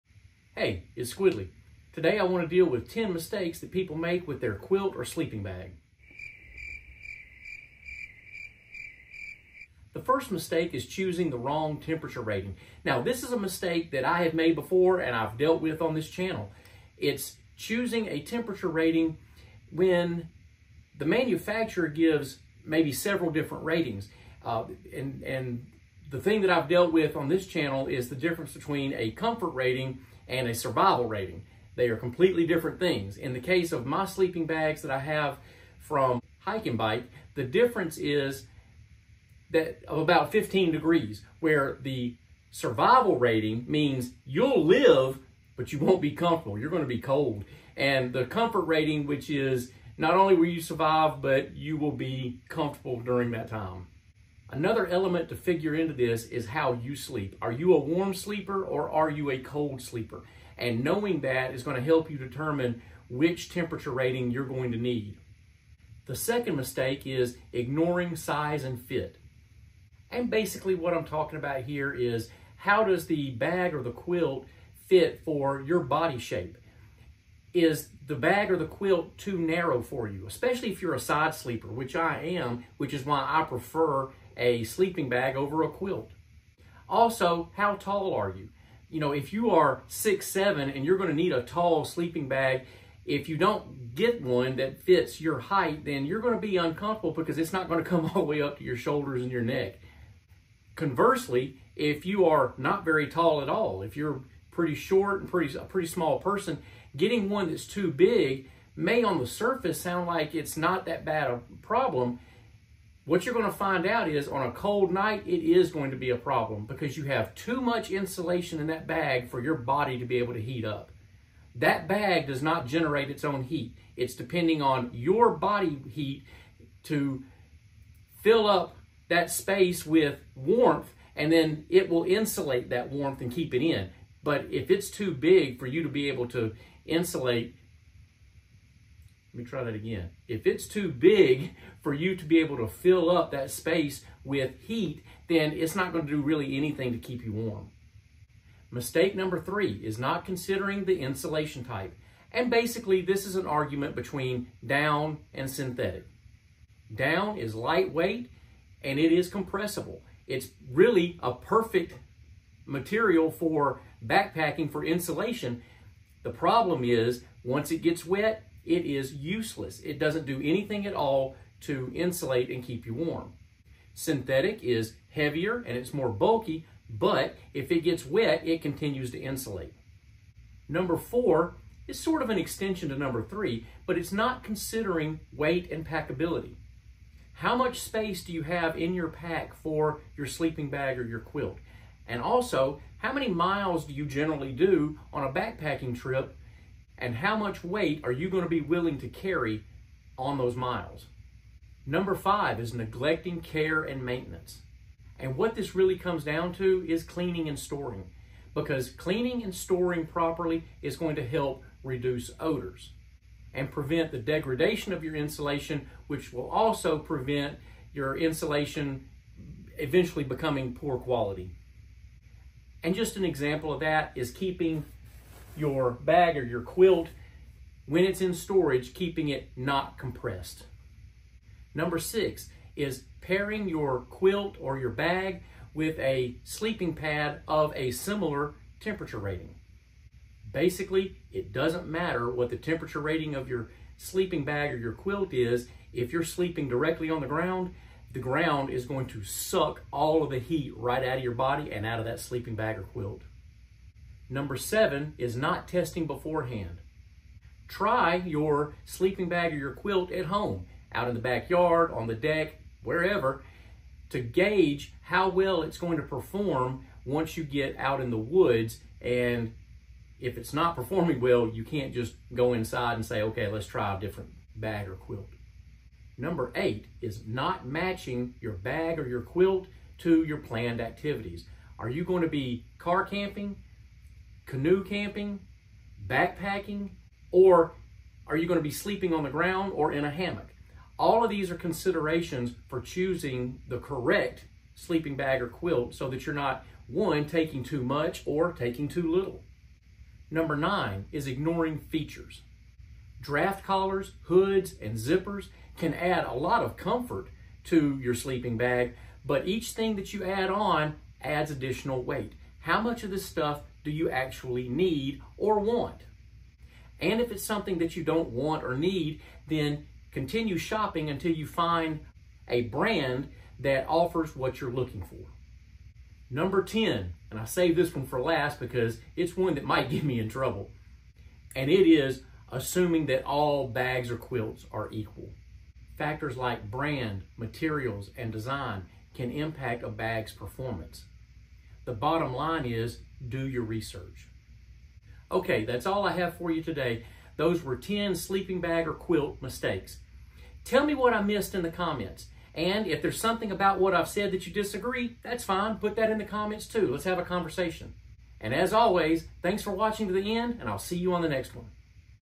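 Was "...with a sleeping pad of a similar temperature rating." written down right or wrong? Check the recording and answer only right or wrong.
right.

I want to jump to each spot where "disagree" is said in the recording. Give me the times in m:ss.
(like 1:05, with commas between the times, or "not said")
5:54.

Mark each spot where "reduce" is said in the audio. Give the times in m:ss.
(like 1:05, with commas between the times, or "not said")
3:31.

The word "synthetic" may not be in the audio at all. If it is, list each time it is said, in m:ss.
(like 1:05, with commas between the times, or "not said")
2:35, 2:53.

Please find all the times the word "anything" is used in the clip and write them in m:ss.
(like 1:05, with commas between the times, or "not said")
2:26, 2:50.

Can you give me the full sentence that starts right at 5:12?
How much of this stuff do you actually need or want?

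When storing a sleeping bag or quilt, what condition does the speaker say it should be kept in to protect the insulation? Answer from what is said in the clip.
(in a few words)
not compressed.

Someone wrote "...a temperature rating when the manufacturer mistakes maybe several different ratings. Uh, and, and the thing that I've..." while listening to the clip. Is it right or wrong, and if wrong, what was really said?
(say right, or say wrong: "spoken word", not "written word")
wrong: "gives", not "mistakes".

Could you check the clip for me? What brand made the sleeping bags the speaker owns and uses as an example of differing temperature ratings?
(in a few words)
Hyke and Byke.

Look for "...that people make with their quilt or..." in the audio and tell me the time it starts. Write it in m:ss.
0:03.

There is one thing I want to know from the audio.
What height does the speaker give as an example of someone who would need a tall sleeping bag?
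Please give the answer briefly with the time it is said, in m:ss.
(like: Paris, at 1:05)
six seven, at 1:29.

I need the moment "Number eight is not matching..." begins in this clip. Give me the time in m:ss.
4:36.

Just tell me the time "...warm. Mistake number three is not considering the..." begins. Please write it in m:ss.
2:27.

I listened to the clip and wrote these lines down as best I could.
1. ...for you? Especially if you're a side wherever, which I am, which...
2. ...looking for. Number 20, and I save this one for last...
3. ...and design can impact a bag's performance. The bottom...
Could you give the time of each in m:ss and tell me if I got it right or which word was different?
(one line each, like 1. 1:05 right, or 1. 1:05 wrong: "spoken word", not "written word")
1. 1:19 wrong: "sleeper", not "wherever"
2. 5:24 wrong: "10", not "20"
3. 5:38 right.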